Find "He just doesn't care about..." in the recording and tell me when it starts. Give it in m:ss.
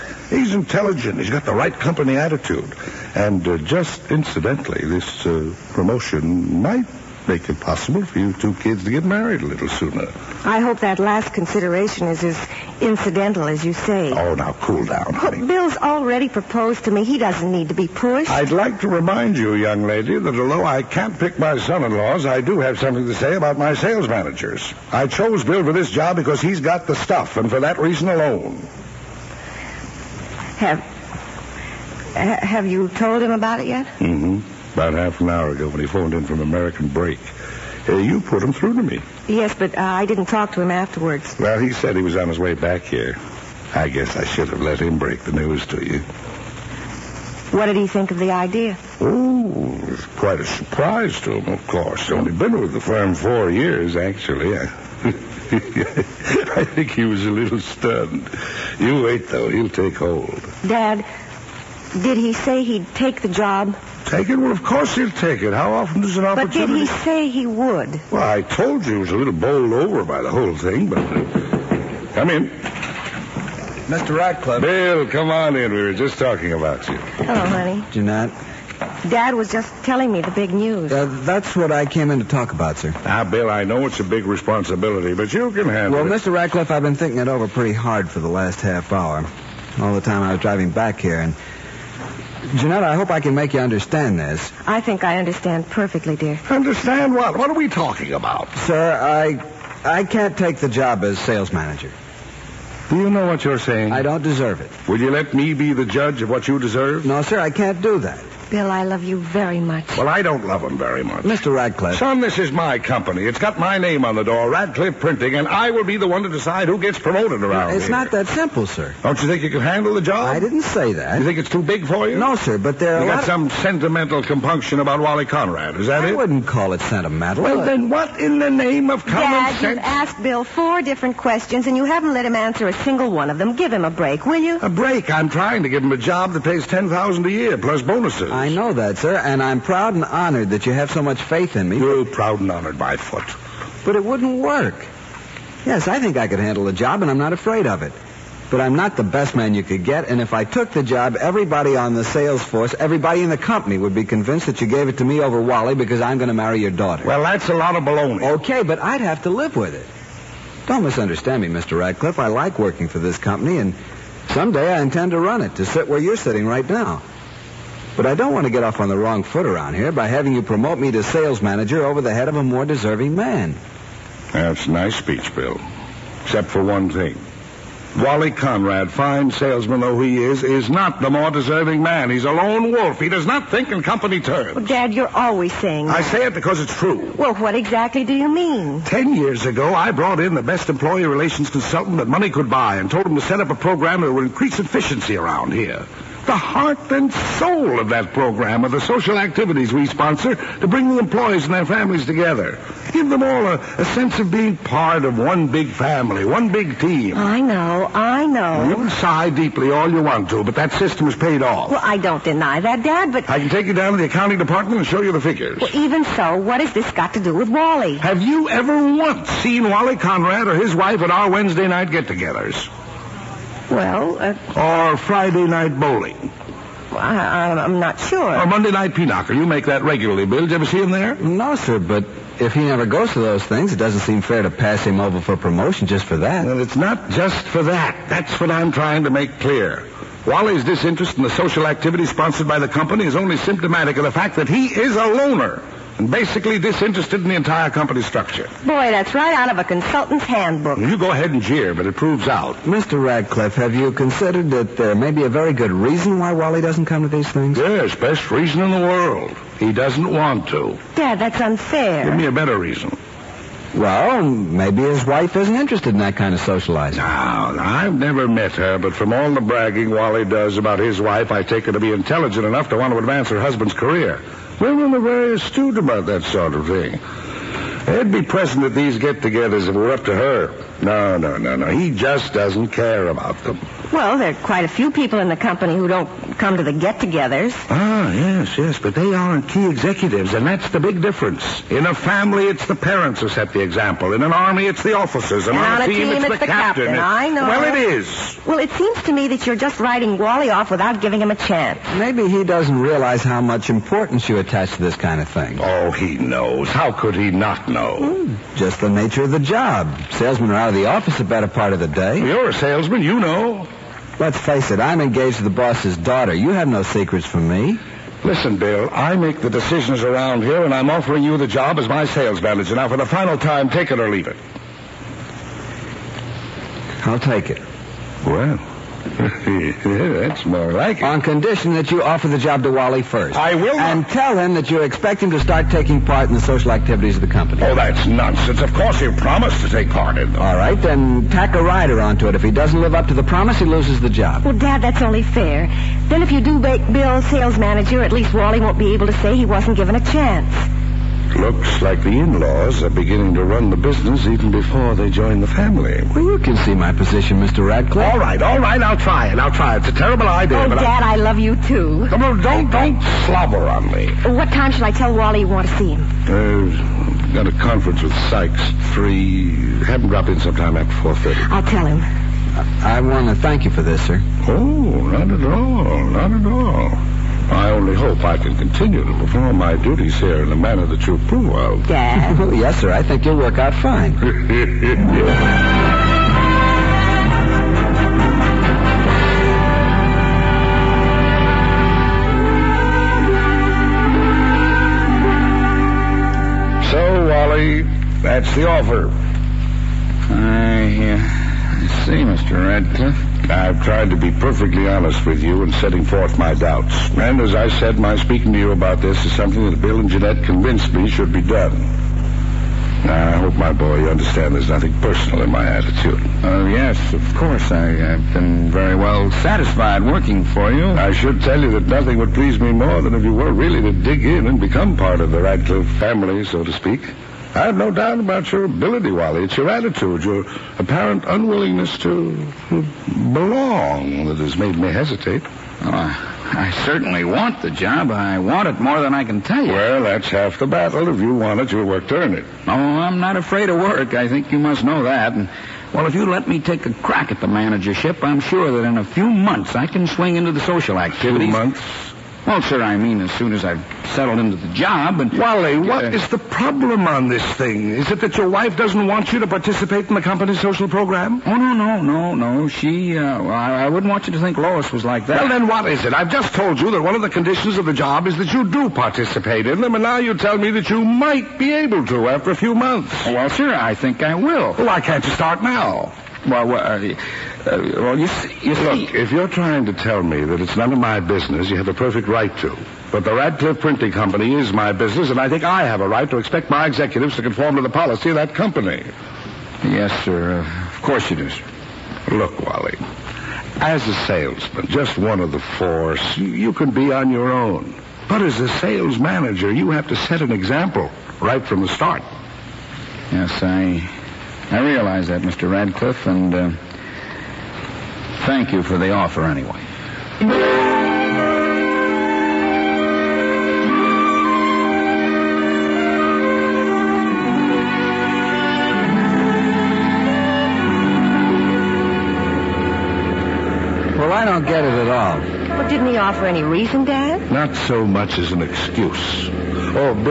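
4:41.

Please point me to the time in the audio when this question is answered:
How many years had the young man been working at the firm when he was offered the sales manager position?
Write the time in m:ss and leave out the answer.
0:53.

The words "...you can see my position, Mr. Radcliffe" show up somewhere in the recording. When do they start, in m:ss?
5:56.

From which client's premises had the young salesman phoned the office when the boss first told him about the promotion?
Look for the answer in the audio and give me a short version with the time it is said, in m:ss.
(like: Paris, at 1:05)
American Brake, at 0:36.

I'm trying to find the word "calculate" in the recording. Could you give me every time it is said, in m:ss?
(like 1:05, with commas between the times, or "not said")
not said.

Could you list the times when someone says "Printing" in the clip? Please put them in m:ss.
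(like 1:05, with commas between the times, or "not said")
1:55, 8:03.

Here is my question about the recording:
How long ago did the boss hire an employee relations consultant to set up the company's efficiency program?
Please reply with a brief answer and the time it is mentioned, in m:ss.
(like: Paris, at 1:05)
10 years, at 3:08.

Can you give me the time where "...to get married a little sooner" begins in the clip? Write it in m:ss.
0:08.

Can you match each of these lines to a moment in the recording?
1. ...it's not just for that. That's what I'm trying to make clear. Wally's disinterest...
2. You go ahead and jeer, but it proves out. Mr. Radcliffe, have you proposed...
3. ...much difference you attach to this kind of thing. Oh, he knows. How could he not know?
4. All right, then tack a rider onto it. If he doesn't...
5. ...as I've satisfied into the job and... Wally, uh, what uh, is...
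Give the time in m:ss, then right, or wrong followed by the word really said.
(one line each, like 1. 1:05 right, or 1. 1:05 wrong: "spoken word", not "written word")
1. 3:56 right
2. 4:10 wrong: "considered", not "proposed"
3. 5:03 wrong: "importance", not "difference"
4. 5:40 right
5. 7:33 wrong: "settled", not "satisfied".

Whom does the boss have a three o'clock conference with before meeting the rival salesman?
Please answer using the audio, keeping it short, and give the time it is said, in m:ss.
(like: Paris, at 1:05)
Sykes, at 6:08.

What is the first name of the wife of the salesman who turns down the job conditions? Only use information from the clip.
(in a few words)
Lois.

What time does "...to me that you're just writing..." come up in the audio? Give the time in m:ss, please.
4:59.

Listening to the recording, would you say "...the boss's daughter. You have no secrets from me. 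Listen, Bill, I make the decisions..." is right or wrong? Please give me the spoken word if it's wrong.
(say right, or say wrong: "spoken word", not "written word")
right.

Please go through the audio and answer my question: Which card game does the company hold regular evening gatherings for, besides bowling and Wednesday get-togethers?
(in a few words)
Pinochle.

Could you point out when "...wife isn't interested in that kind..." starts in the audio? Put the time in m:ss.
4:25.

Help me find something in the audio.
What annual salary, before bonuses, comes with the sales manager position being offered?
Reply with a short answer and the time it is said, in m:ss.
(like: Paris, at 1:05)
10,000, at 2:16.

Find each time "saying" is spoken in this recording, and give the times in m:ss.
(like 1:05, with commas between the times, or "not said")
1:43, 3:05.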